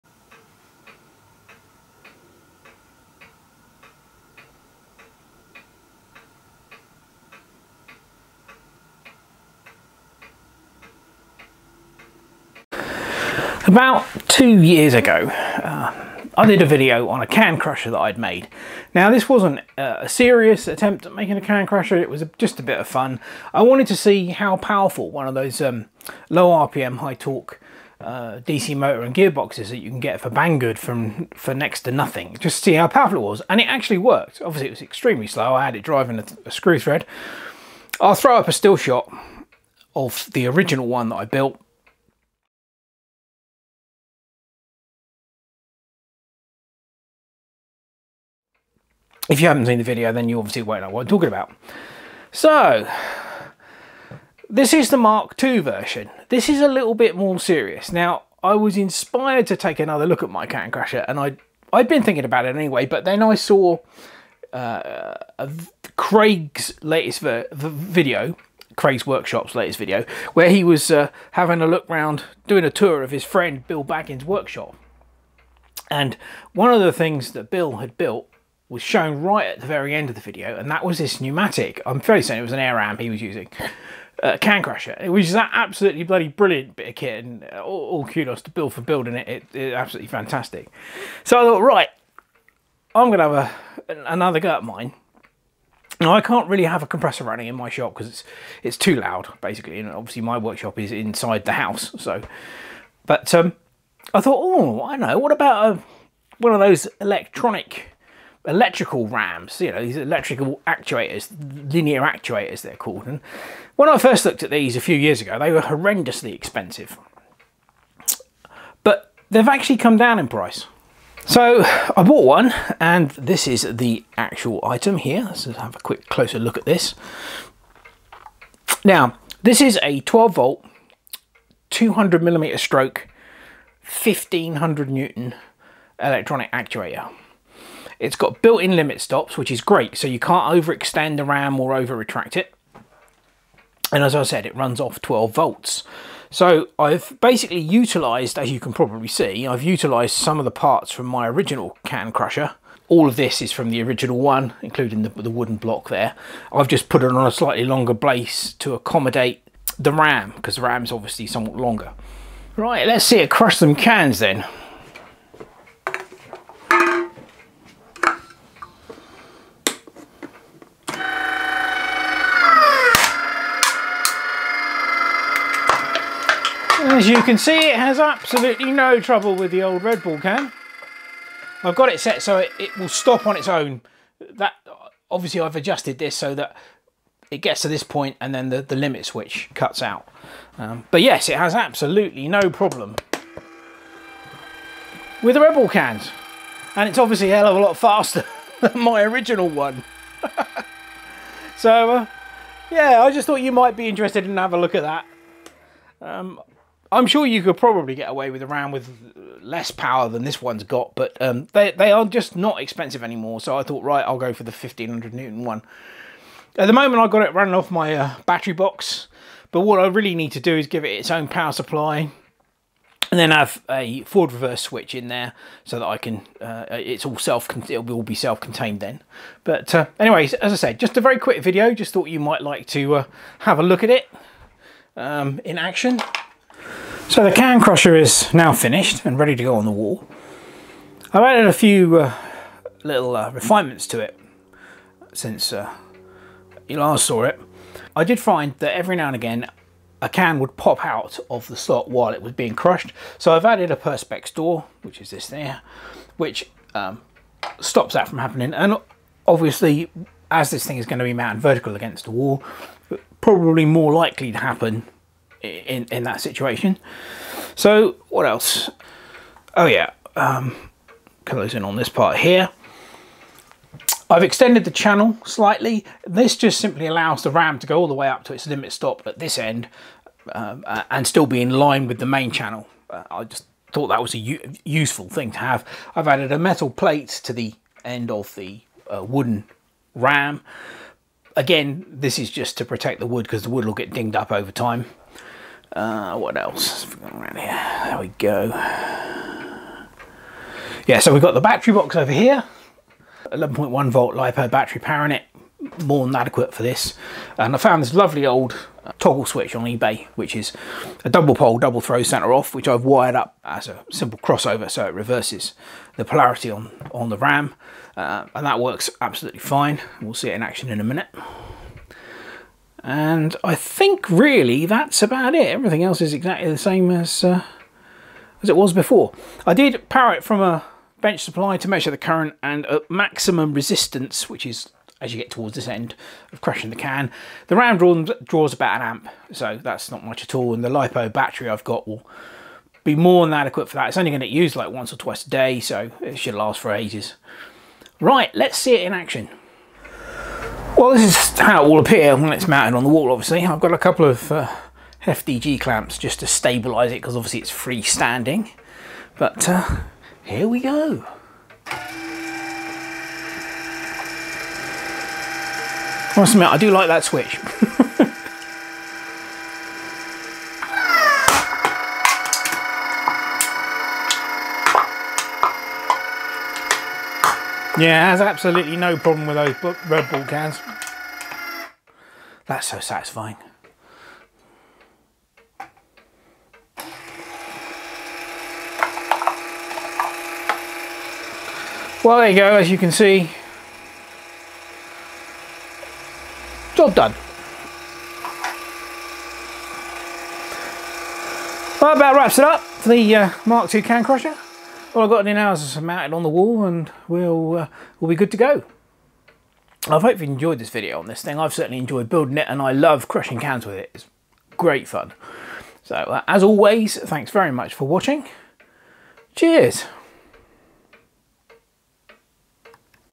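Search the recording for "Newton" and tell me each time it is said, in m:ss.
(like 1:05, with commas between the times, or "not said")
2:14, 3:35.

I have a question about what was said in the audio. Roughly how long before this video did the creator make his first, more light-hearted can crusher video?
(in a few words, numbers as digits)
About two years.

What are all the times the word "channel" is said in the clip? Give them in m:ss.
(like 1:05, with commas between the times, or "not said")
4:34, 4:42.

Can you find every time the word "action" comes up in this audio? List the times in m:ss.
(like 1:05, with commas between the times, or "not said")
3:55, 5:20, 5:48.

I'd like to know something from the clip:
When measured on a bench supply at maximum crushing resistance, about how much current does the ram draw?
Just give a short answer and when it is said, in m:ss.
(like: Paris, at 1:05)
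About 1 amp, at 5:38.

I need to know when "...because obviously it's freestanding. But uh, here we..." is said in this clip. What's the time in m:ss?
5:57.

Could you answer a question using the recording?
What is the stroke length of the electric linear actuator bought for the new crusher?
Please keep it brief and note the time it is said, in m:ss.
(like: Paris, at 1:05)
200 millimeters, at 2:11.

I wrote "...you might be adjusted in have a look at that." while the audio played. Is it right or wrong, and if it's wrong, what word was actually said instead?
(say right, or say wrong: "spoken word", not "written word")
wrong: "interested", not "adjusted".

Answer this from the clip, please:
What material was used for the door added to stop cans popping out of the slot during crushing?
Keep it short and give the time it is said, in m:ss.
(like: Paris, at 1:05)
Perspex, at 4:13.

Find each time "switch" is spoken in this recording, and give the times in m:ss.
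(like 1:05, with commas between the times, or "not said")
3:09, 3:44, 5:09, 6:07.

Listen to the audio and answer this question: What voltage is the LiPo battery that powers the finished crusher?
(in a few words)
11.1 volts.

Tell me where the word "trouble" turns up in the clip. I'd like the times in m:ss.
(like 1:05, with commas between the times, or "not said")
2:58.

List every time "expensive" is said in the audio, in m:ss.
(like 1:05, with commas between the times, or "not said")
1:56, 3:32.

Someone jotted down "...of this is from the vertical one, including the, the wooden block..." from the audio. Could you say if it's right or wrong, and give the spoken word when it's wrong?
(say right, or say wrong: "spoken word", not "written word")
wrong: "original", not "vertical".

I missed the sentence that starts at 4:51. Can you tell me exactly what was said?
Again, this is just to protect the wood because the wood will get dinged up over time.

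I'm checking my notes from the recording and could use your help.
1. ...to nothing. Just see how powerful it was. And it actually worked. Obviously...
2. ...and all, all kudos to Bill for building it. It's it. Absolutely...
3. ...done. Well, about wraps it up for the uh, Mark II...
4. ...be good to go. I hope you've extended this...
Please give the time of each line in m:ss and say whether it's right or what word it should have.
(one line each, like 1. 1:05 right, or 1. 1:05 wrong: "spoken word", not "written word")
1. 0:31 right
2. 1:27 right
3. 6:36 right
4. 6:48 wrong: "enjoyed", not "extended".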